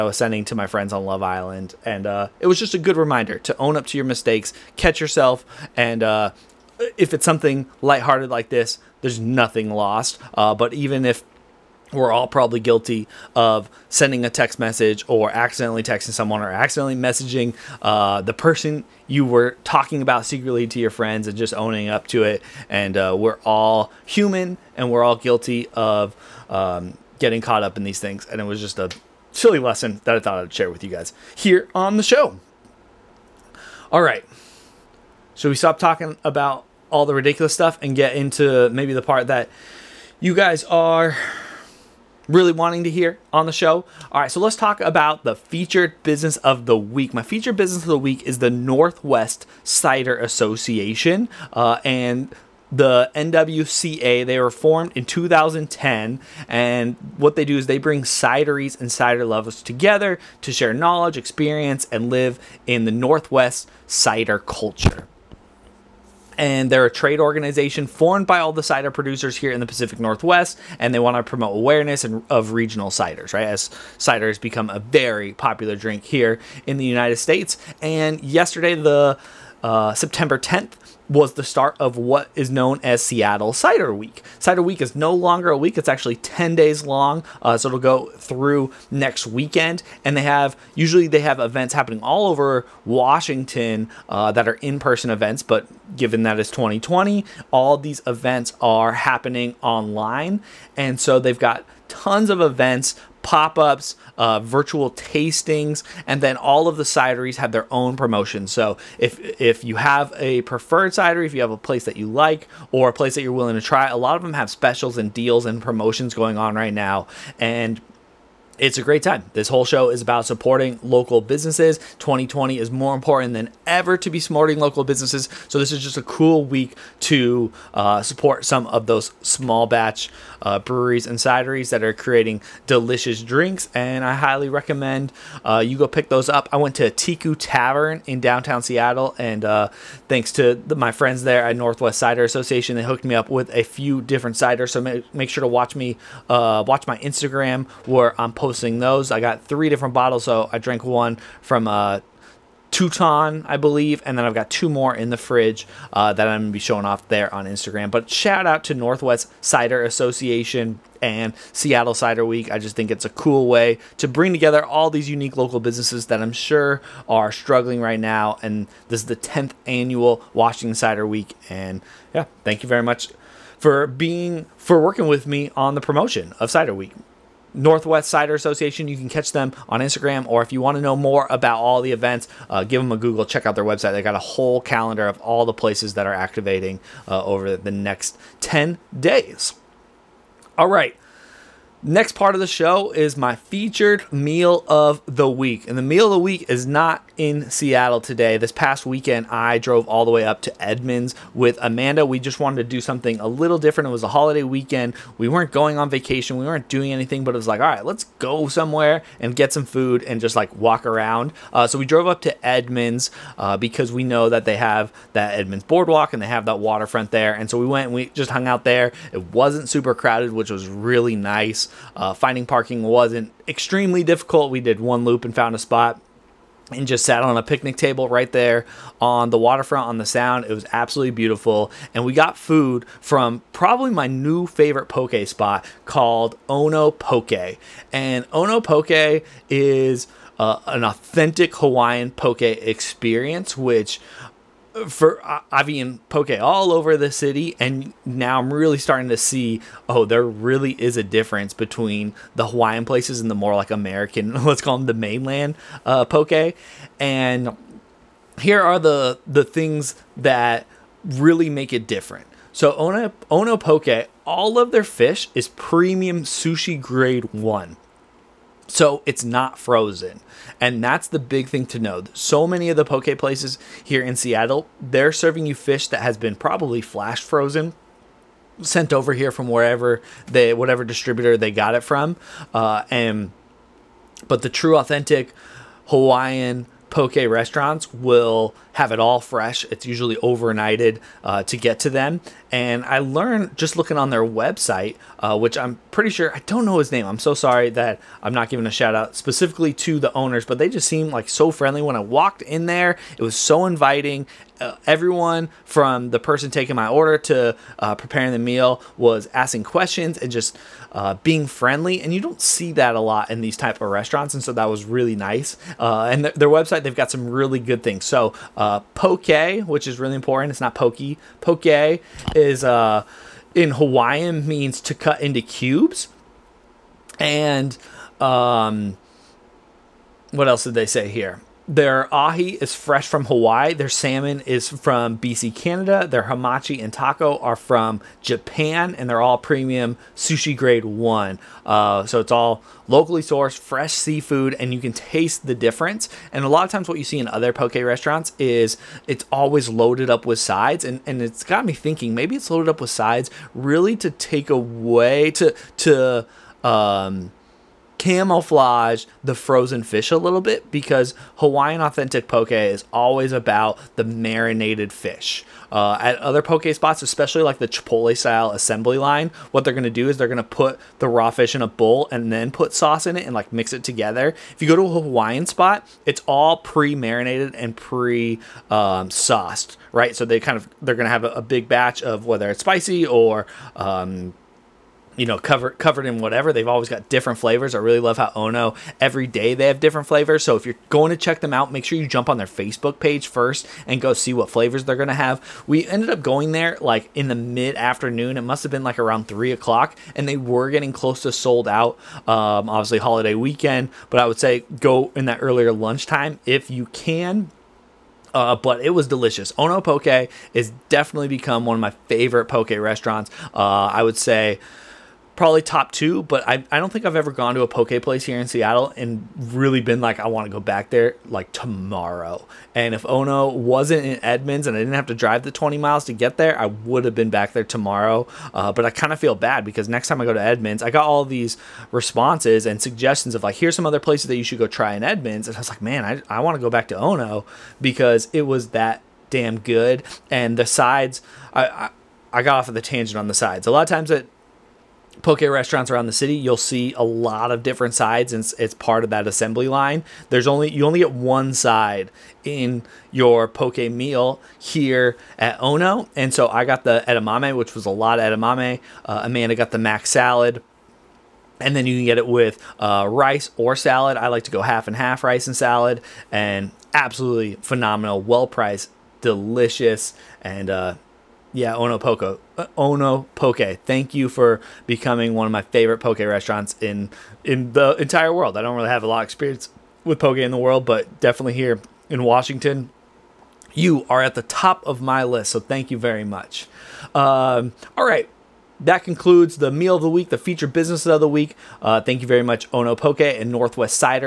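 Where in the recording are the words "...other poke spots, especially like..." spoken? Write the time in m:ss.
6:06.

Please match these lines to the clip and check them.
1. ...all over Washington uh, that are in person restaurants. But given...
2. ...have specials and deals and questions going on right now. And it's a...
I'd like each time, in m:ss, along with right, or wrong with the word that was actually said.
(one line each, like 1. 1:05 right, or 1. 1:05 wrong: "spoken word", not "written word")
1. 1:32 wrong: "events", not "restaurants"
2. 1:54 wrong: "promotions", not "questions".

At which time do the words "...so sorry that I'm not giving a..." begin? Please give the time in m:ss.
4:57.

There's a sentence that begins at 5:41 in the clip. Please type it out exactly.
Uh, so it's all locally sourced, fresh seafood, and you can taste the difference.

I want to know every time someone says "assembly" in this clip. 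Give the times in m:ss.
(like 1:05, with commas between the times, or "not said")
6:08, 7:29.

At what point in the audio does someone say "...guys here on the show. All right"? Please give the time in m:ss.
0:30.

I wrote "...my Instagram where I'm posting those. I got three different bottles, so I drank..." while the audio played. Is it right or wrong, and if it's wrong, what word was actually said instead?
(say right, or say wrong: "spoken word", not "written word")
right.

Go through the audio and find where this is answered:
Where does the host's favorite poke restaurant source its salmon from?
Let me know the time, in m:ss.
5:35.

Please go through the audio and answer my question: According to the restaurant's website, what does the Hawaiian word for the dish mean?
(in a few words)
to cut into cubes.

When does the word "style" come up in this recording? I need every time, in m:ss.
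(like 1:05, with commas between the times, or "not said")
6:08.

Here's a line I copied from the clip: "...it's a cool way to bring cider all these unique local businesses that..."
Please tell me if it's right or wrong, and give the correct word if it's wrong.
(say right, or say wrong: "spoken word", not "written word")
wrong: "together", not "cider".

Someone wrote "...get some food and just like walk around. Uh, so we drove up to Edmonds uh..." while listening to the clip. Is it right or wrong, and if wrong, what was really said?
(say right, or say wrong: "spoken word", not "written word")
right.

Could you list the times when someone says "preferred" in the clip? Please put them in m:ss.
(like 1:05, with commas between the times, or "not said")
1:50.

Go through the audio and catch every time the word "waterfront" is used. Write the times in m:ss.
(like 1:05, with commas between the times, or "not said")
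3:36, 3:49.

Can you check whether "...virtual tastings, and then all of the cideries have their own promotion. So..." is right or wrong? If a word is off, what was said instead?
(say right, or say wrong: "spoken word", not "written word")
right.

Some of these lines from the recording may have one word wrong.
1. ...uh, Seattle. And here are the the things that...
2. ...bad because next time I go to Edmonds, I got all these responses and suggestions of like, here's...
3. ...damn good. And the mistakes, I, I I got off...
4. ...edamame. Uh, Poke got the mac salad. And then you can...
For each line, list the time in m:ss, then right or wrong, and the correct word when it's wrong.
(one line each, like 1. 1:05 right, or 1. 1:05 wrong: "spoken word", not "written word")
1. 4:15 wrong: "Poke", not "Seattle"
2. 7:09 right
3. 7:19 wrong: "sides", not "mistakes"
4. 7:38 wrong: "Amanda", not "Poke".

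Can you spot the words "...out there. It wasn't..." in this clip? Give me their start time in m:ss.
3:38.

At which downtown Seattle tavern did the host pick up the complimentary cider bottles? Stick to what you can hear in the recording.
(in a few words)
Teku Tavern.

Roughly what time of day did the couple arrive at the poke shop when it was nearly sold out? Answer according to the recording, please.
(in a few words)
3 o'clock.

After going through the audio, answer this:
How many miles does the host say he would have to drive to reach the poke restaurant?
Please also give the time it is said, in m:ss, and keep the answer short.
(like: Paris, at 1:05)
20 miles, at 7:05.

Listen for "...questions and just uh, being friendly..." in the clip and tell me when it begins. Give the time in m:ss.
5:09.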